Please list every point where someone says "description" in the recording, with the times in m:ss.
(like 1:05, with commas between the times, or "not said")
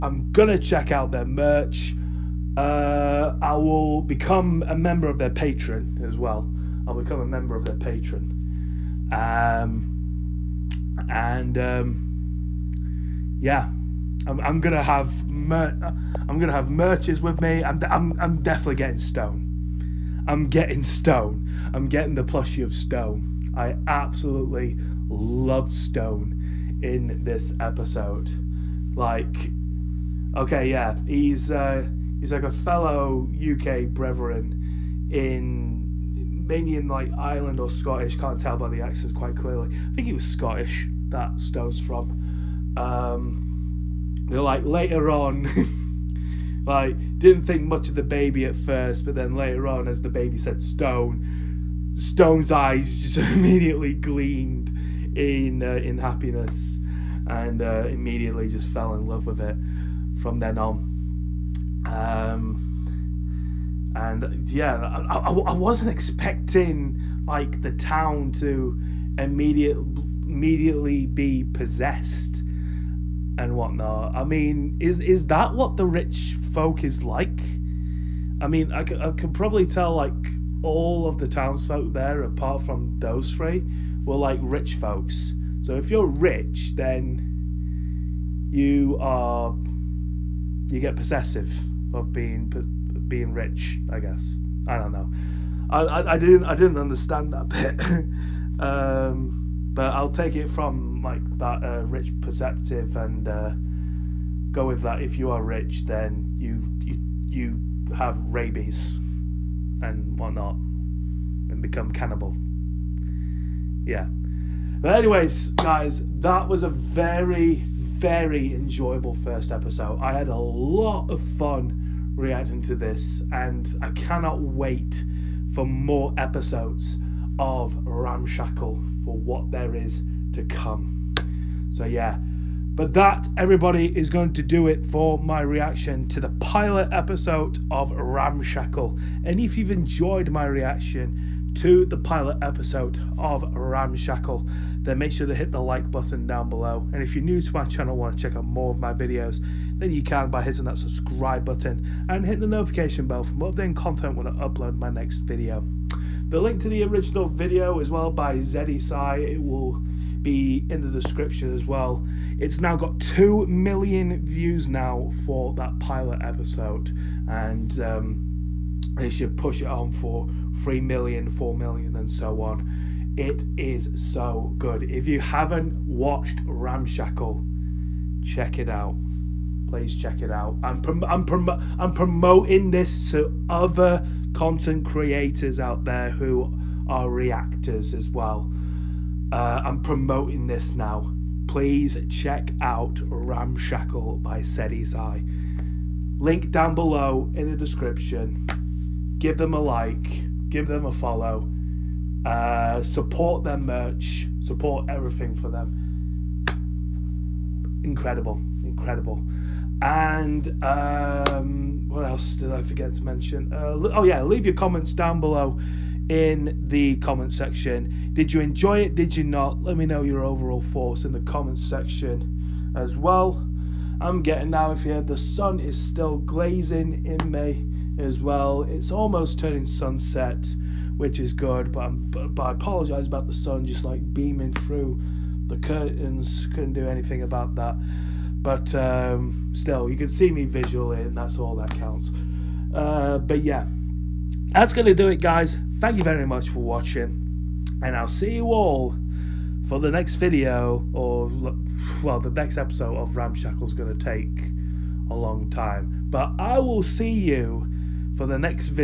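2:40, 3:17.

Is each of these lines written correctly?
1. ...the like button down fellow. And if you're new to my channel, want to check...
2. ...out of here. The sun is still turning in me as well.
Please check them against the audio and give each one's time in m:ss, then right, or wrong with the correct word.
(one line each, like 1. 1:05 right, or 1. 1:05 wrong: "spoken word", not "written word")
1. 2:25 wrong: "below", not "fellow"
2. 3:44 wrong: "glazing", not "turning".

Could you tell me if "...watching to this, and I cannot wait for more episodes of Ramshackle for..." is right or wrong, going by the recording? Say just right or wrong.
wrong.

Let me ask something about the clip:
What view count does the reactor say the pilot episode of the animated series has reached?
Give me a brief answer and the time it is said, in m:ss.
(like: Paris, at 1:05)
2 million, at 2:42.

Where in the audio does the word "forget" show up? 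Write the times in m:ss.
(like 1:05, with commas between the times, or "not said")
3:32.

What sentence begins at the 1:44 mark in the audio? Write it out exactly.
If you are rich, then you you you have rabies and whatnot and become cannibal.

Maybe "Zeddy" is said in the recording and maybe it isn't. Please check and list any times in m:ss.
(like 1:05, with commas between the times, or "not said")
2:38, 3:14.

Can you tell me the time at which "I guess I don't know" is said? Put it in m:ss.
1:33.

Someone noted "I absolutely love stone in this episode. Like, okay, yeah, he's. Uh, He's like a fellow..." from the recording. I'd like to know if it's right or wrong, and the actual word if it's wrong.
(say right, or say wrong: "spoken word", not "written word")
right.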